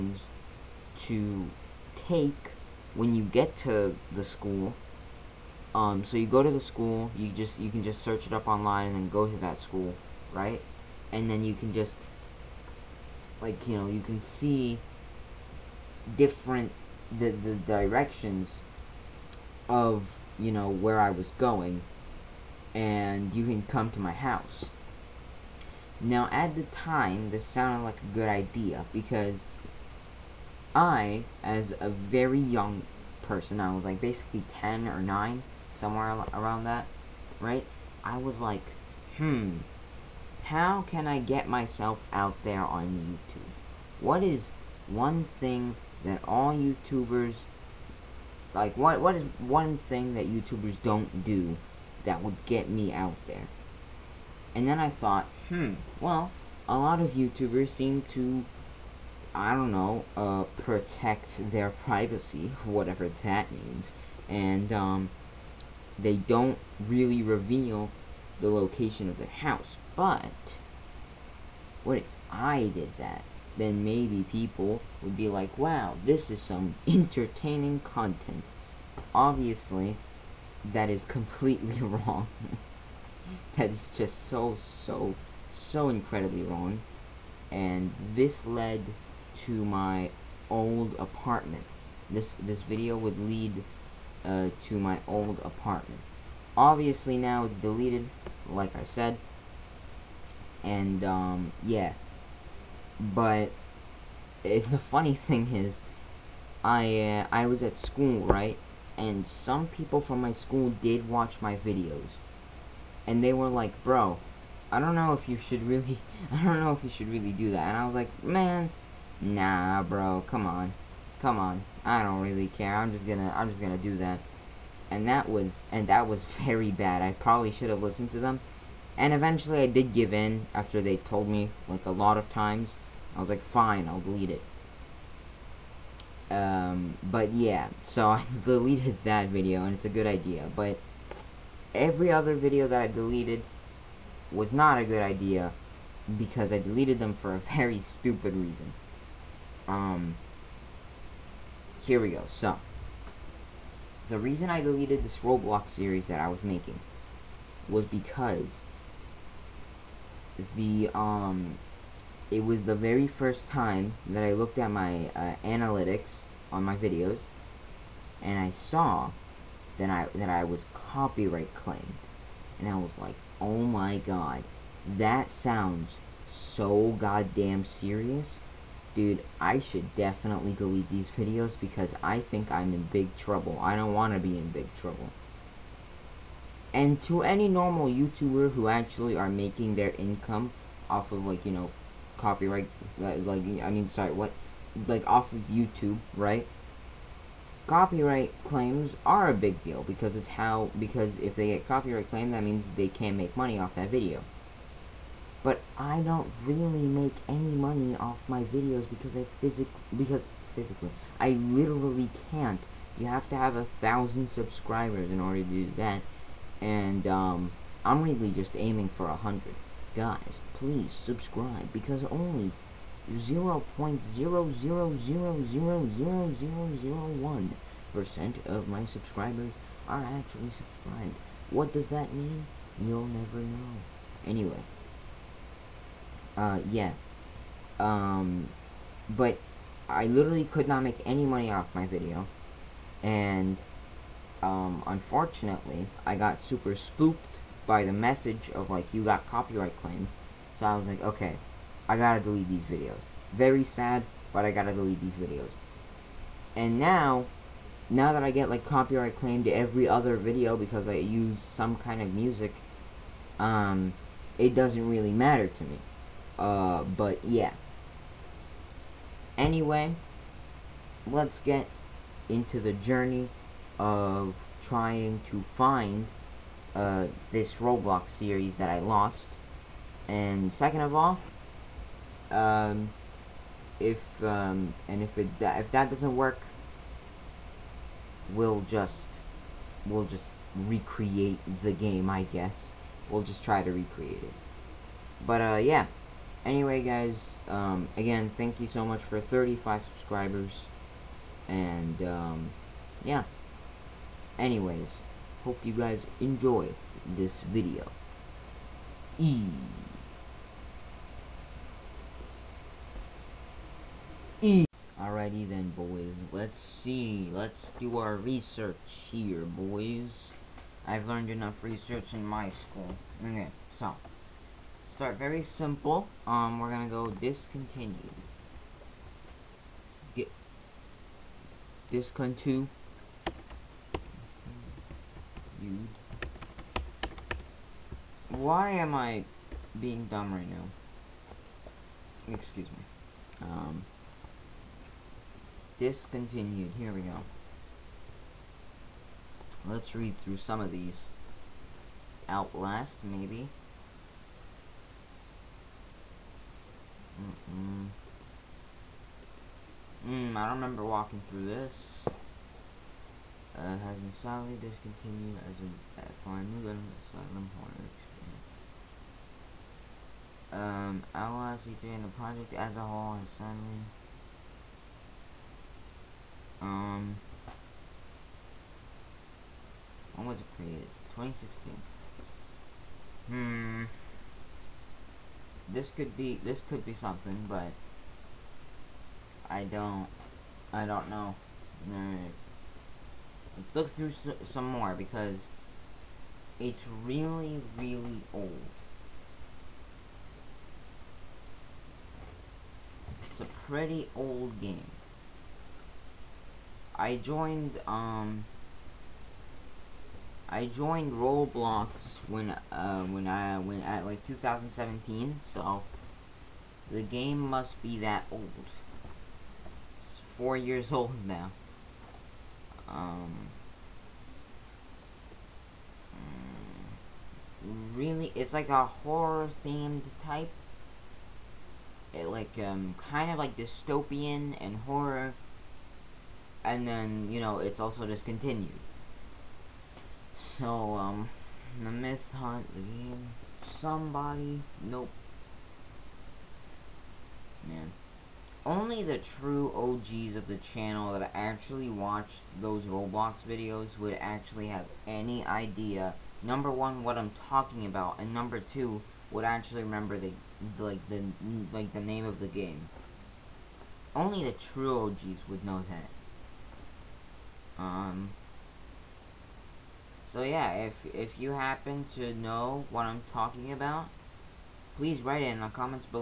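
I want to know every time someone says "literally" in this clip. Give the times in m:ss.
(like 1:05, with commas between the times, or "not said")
3:31, 4:00.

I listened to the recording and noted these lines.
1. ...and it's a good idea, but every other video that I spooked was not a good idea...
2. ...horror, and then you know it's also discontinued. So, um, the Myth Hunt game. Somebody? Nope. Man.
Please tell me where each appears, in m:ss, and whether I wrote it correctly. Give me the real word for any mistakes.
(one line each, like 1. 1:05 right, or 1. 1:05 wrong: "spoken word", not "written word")
1. 2:19 wrong: "deleted", not "spooked"
2. 7:14 right.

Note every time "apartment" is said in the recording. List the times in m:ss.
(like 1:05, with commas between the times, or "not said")
1:30, 1:35.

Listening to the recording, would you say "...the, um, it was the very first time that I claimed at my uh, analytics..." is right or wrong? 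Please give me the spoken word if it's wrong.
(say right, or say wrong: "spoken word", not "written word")
wrong: "looked", not "claimed".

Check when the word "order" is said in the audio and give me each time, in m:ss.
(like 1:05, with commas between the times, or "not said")
3:35.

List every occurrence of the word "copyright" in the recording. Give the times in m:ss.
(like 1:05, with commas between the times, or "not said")
2:50, 3:12, 3:17, 3:21, 4:09, 4:18.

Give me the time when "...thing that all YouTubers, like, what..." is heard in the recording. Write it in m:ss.
0:45.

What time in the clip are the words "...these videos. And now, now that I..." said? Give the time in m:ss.
4:15.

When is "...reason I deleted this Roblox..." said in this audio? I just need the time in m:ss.
2:34.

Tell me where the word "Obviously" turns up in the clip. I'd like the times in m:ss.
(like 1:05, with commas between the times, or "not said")
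1:19, 1:36.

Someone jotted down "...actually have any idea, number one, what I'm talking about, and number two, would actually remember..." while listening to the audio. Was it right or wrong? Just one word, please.
right.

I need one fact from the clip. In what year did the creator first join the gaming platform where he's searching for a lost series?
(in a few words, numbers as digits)
2017.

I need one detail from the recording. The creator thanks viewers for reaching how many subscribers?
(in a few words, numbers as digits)
35.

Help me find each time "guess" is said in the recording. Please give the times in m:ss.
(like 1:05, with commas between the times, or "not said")
4:52.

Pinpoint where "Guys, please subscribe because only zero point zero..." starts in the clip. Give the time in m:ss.
3:39.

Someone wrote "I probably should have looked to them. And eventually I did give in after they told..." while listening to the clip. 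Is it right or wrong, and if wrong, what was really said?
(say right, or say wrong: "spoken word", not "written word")
wrong: "listened", not "looked".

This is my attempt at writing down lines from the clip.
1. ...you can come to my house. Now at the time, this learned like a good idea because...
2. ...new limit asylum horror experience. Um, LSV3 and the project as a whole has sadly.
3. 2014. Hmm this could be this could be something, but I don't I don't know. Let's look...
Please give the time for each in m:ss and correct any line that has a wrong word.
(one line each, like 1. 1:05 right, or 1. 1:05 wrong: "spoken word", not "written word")
1. 0:23 wrong: "sounded", not "learned"
2. 6:06 right
3. 6:21 wrong: "2016", not "2014".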